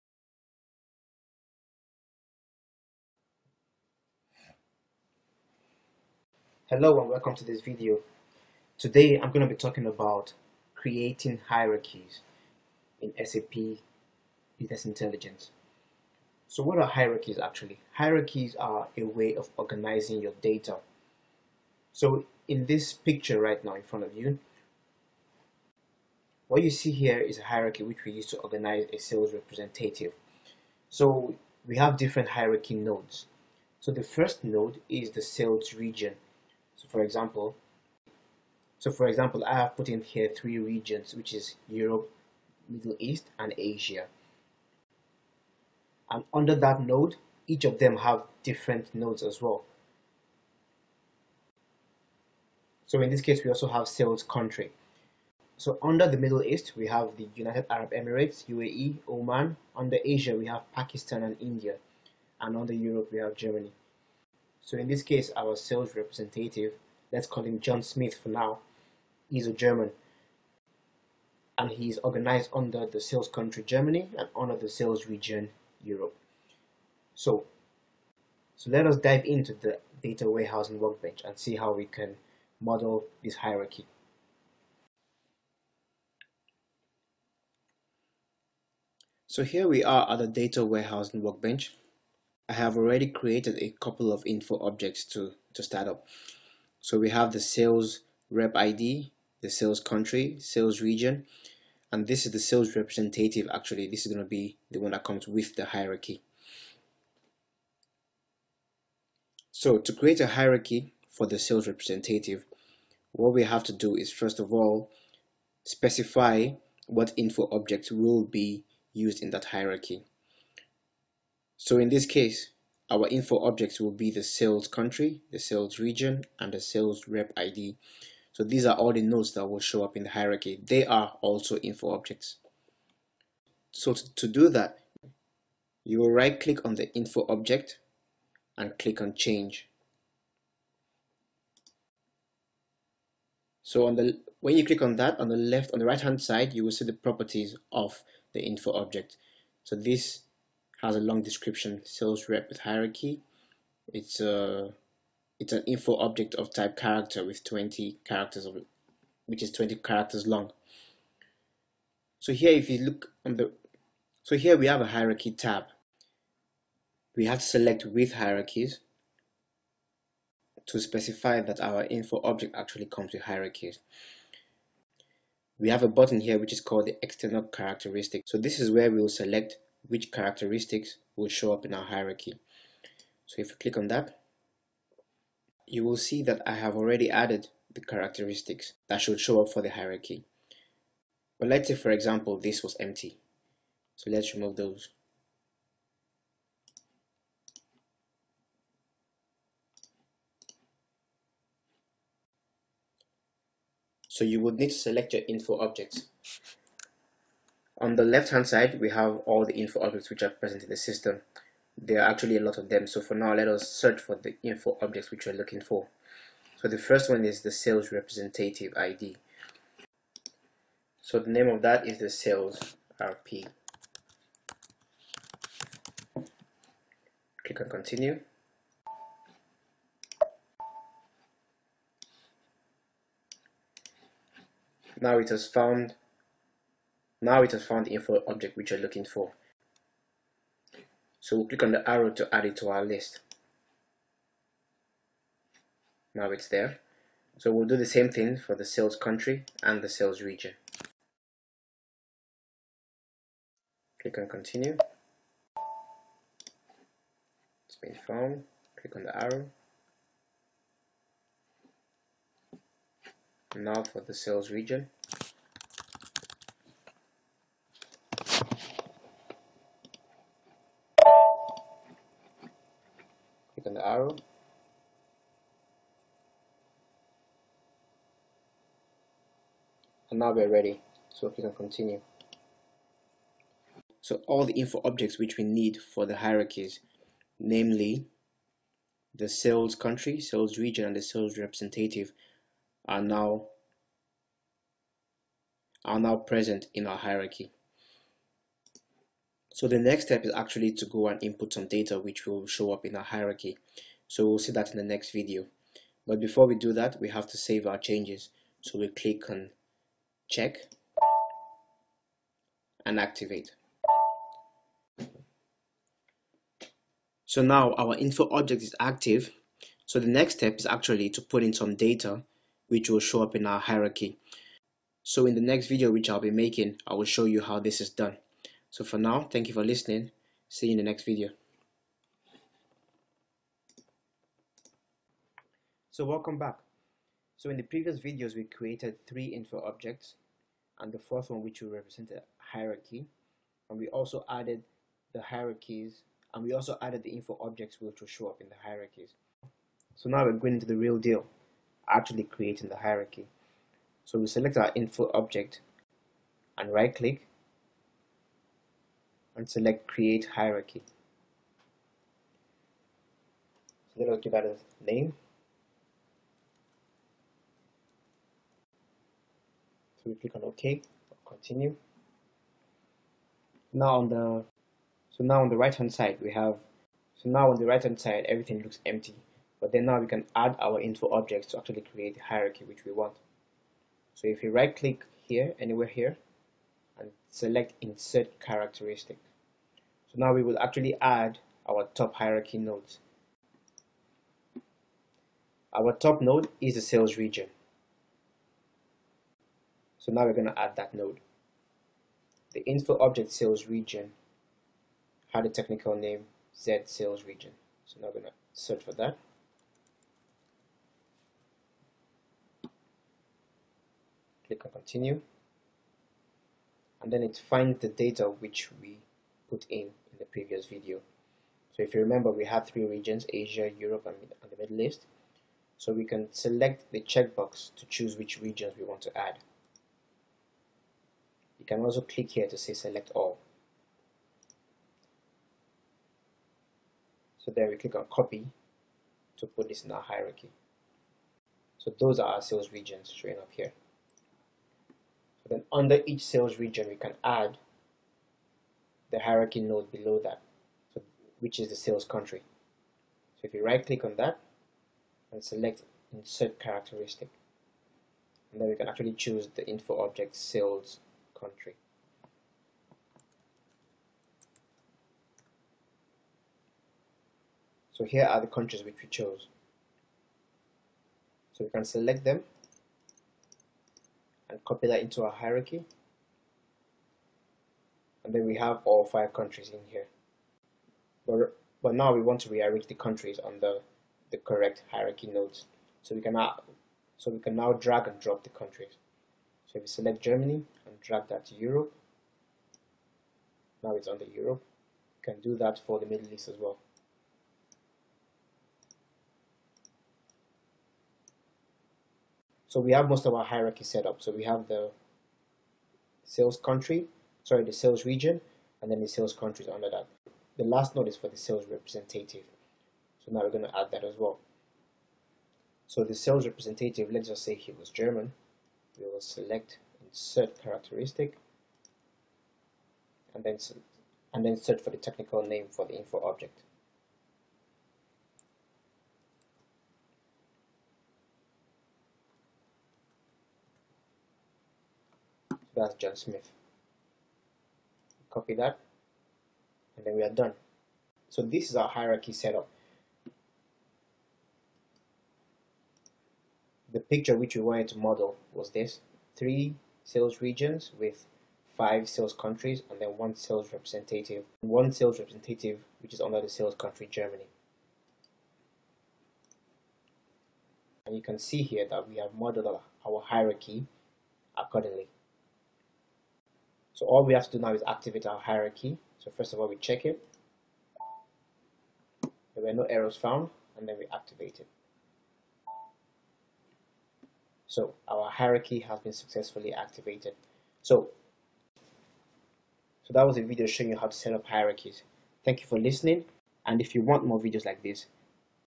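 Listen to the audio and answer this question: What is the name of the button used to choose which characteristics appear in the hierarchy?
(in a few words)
external characteristic.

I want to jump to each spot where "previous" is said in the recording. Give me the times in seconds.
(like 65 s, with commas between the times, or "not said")
337 s, 420 s.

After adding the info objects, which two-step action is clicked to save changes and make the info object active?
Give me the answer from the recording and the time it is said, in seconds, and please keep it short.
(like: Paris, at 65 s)
check and activate, at 310 s.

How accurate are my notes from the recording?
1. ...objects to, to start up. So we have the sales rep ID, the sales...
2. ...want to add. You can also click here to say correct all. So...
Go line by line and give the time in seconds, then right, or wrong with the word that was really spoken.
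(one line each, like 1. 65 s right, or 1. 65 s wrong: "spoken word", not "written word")
1. 94 s right
2. 428 s wrong: "select", not "correct".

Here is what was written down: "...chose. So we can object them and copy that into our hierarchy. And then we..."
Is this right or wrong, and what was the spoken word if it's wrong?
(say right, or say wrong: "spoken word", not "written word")
wrong: "select", not "object".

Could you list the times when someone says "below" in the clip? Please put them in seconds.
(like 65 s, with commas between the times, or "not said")
449 s.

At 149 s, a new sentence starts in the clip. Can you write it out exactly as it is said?
So this has a long description, sales rep with hierarchy.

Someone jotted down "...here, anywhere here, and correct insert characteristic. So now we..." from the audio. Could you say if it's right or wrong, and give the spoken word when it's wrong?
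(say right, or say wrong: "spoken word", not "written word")
wrong: "select", not "correct".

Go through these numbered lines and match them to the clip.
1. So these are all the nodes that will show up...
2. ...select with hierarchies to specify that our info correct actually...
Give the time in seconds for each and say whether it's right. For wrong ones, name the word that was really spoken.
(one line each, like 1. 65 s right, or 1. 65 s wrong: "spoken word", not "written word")
1. 128 s right
2. 167 s wrong: "object", not "correct".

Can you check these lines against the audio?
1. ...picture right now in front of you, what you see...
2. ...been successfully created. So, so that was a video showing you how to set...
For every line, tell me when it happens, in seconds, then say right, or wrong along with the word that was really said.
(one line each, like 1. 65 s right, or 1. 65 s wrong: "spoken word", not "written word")
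1. 22 s right
2. 578 s wrong: "activated", not "created".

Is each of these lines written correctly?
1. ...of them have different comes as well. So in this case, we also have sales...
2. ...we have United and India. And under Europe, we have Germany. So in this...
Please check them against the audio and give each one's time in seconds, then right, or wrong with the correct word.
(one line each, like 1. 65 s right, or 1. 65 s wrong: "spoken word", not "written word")
1. 47 s wrong: "nodes", not "comes"
2. 60 s wrong: "Pakistan", not "United".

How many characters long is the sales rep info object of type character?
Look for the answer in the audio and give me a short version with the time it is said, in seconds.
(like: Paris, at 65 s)
20, at 159 s.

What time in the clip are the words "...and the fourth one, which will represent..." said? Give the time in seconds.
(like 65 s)
340 s.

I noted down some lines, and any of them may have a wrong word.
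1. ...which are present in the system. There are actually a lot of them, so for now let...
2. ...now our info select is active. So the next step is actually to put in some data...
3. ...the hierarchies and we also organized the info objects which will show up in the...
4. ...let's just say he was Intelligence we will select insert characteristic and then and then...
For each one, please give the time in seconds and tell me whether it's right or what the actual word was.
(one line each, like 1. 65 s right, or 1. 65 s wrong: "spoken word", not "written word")
1. 210 s right
2. 317 s wrong: "object", not "select"
3. 345 s wrong: "added", not "organized"
4. 517 s wrong: "German", not "Intelligence".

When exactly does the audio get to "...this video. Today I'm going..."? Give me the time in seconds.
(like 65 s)
7 s.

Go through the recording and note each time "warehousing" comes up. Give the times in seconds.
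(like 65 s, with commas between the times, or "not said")
80 s, 90 s.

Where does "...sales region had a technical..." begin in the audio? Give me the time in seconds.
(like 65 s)
403 s.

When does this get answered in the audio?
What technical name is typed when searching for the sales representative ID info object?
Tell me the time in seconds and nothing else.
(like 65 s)
222 s.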